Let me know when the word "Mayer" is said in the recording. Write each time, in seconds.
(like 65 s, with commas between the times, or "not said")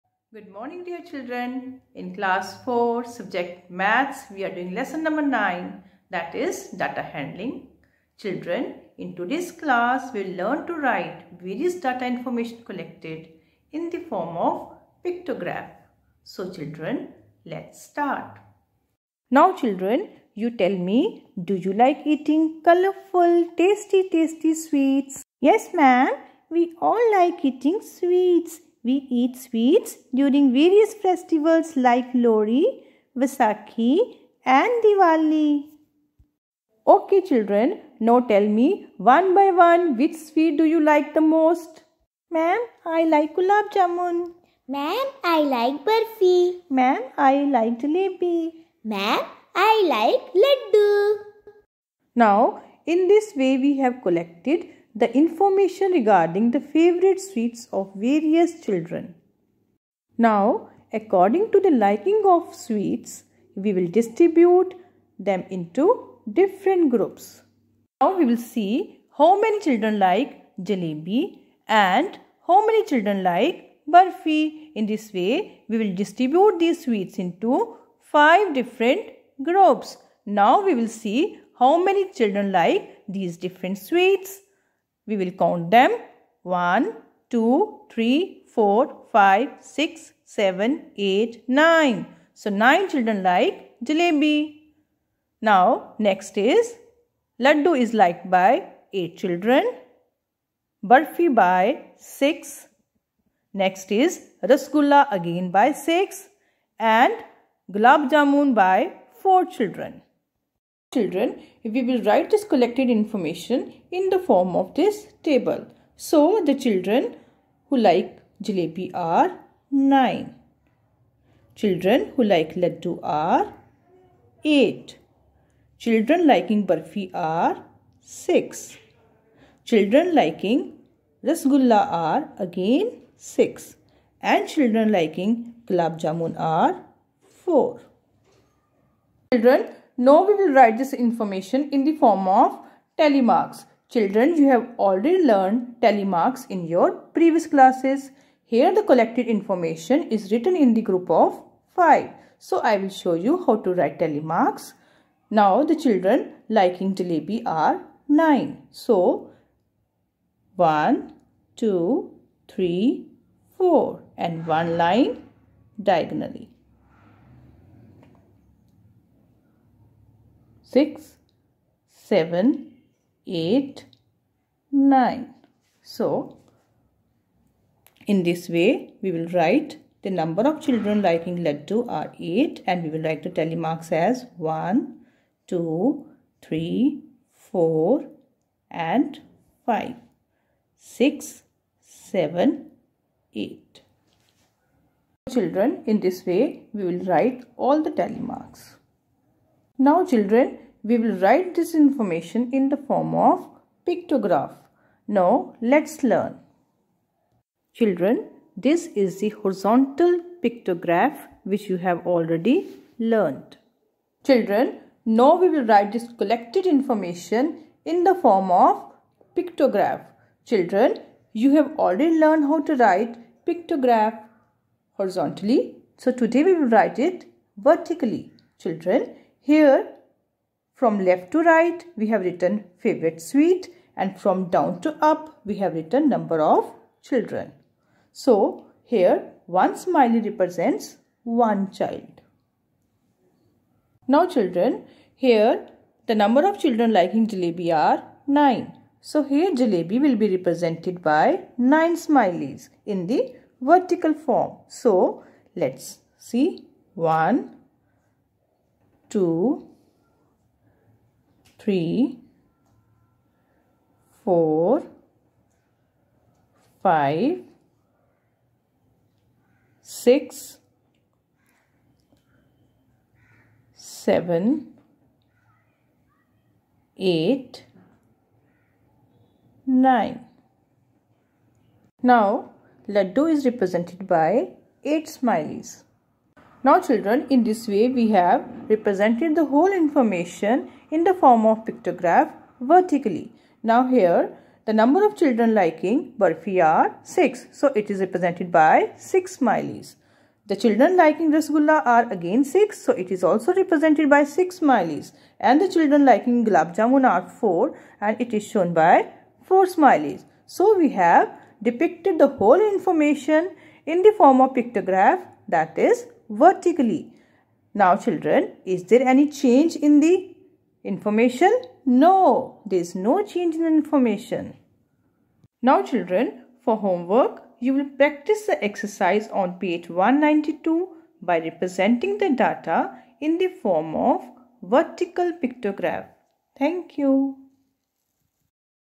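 not said.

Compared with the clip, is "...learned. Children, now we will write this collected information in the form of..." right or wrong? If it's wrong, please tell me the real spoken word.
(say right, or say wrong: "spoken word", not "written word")
right.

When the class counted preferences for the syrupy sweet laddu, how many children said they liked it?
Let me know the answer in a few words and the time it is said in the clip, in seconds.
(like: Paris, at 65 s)
8, at 97 s.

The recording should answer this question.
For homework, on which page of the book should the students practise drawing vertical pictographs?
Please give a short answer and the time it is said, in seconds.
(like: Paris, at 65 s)
192, at 329 s.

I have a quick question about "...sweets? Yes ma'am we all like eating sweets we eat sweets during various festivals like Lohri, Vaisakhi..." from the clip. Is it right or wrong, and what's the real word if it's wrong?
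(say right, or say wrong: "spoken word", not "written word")
right.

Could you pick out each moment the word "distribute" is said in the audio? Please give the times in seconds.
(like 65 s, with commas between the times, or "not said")
63 s, 75 s.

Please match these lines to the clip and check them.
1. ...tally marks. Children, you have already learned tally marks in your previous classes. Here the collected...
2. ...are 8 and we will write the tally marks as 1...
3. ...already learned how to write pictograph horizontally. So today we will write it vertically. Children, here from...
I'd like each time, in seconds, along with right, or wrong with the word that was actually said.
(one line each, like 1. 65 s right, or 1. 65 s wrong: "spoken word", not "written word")
1. 142 s right
2. 181 s right
3. 221 s right.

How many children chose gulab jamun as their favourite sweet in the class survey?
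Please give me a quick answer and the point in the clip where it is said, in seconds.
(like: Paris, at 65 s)
4, at 107 s.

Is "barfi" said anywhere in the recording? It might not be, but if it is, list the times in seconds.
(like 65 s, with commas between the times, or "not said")
45 s, 100 s, 126 s.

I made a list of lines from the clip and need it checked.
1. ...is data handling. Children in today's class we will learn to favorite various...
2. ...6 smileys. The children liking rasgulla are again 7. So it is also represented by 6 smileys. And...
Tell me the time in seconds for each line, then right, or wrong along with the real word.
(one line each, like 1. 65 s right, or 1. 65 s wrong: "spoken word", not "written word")
1. 6 s wrong: "write", not "favorite"
2. 298 s wrong: "6", not "7".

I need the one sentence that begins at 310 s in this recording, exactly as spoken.
So we have depicted the whole information in the form of pictograph that is vertically.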